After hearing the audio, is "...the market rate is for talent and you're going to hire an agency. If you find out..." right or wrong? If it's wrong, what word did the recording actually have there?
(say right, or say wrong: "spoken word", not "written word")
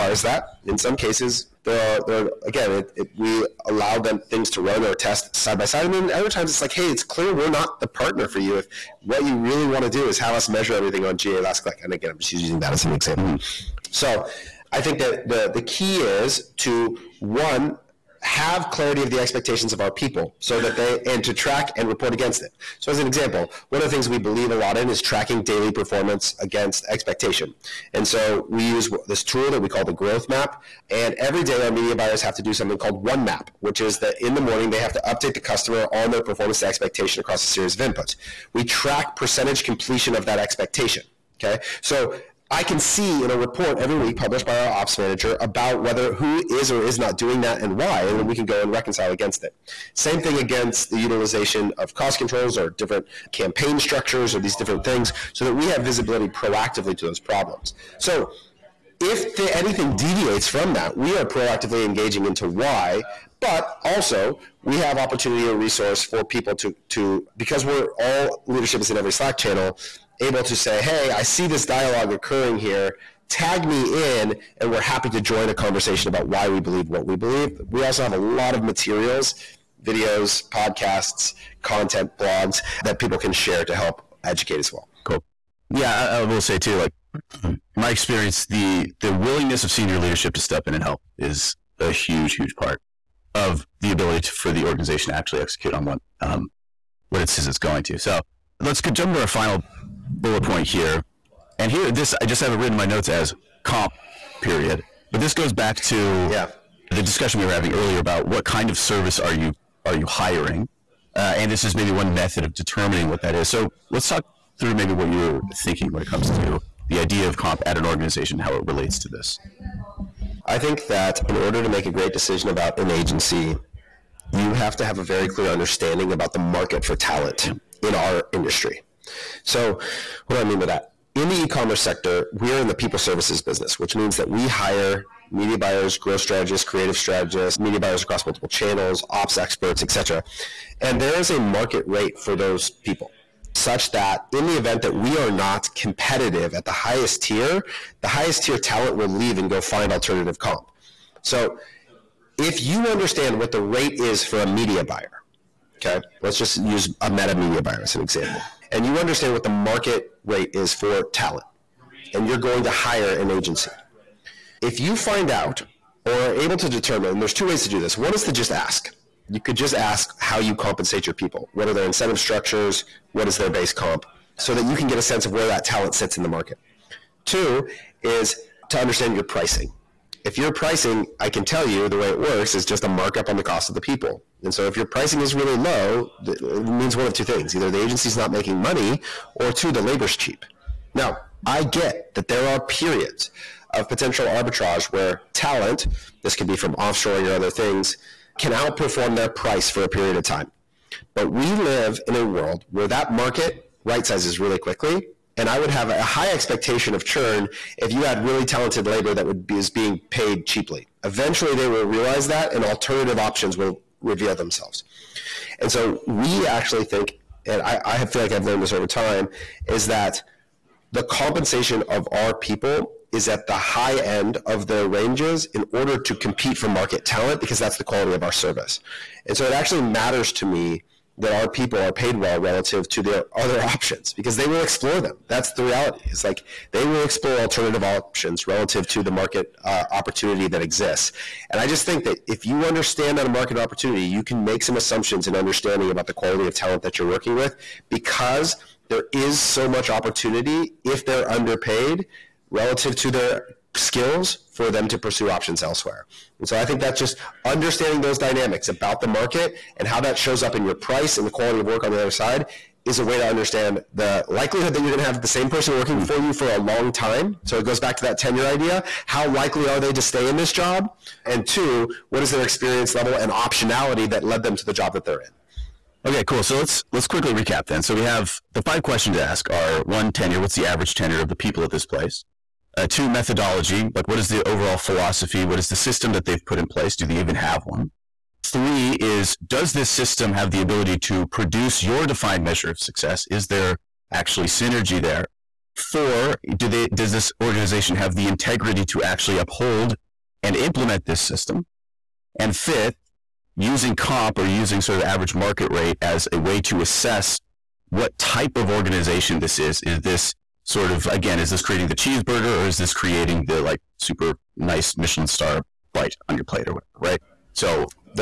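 right.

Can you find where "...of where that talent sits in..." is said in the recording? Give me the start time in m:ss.
2:55.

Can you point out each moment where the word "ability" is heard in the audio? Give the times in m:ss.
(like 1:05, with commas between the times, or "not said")
1:33, 4:50.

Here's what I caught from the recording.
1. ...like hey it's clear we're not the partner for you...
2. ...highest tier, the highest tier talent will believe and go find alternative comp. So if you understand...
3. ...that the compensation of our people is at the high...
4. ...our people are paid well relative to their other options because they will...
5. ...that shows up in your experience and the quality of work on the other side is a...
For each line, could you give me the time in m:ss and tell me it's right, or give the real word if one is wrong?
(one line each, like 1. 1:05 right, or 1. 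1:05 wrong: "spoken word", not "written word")
1. 0:06 right
2. 2:26 wrong: "leave", not "believe"
3. 3:39 right
4. 3:51 right
5. 4:19 wrong: "price", not "experience".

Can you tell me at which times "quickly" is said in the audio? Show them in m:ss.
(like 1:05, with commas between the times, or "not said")
3:24, 4:37.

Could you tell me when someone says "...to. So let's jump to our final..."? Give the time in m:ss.
1:37.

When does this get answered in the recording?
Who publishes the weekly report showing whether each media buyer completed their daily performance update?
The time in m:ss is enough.
0:44.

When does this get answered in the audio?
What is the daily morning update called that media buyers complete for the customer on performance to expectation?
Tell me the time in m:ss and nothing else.
0:33.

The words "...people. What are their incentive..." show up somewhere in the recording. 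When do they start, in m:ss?
2:51.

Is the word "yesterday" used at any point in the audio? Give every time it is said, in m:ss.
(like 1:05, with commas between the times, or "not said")
not said.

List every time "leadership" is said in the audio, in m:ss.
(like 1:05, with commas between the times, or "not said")
1:08, 1:29.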